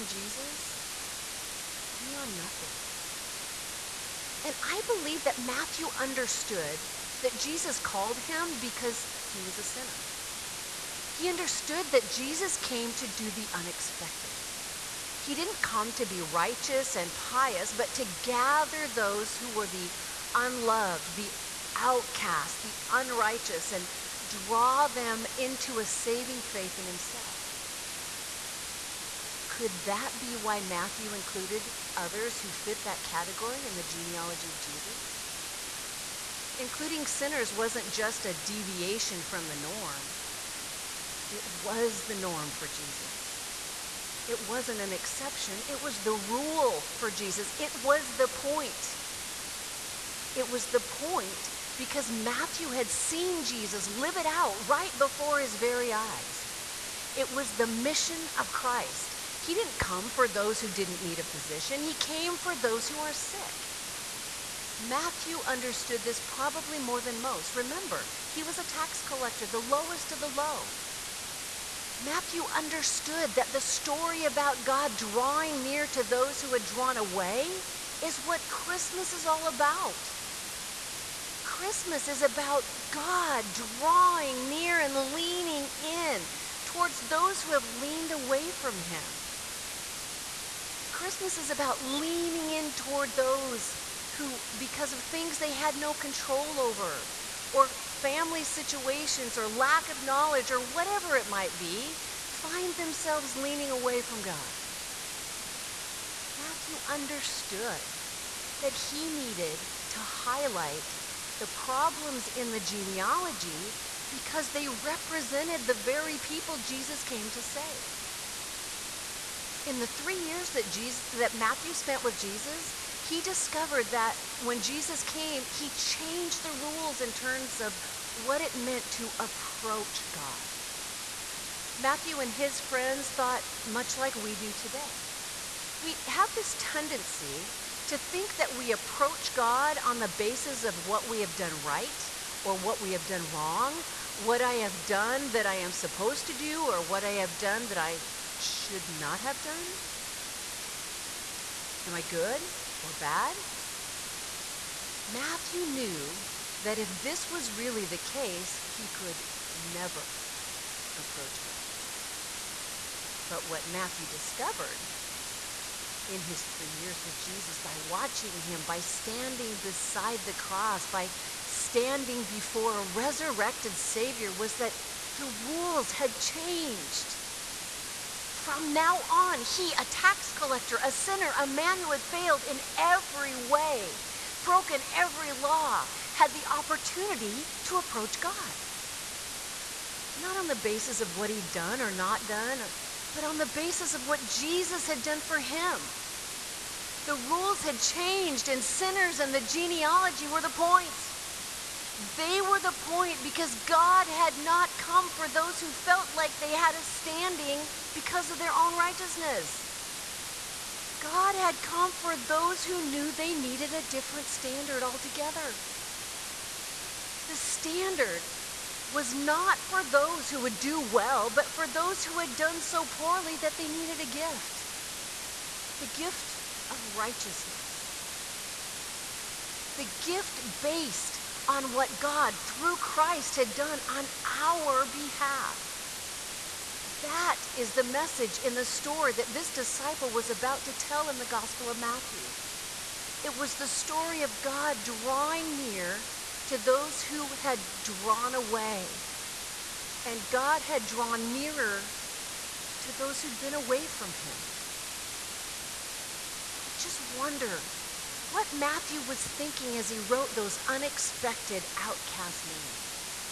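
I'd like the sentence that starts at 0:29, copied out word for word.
Could that be why Matthew included others who fit that category in the genealogy of Jesus?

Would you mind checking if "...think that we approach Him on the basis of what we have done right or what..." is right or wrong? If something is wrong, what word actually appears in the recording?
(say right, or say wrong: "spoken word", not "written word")
wrong: "God", not "Him".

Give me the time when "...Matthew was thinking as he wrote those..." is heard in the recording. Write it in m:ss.
4:18.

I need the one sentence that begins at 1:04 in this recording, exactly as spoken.
Matthew understood this probably more than most.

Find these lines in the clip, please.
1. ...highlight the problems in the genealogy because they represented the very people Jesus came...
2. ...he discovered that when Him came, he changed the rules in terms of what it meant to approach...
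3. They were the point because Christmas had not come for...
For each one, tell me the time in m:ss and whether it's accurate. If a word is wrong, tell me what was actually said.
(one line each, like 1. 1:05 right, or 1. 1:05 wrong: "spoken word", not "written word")
1. 1:49 right
2. 2:03 wrong: "Jesus", not "Him"
3. 3:21 wrong: "God", not "Christmas".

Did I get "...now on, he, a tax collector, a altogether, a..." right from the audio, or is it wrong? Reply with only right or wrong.
wrong.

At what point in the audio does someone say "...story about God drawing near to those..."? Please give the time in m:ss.
1:13.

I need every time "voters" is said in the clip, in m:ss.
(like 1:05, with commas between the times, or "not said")
not said.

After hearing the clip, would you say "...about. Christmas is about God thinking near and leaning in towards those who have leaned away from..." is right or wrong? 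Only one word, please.
wrong.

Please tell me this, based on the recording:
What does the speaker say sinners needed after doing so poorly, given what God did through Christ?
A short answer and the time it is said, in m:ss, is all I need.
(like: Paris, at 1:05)
Gift of righteousness, at 3:45.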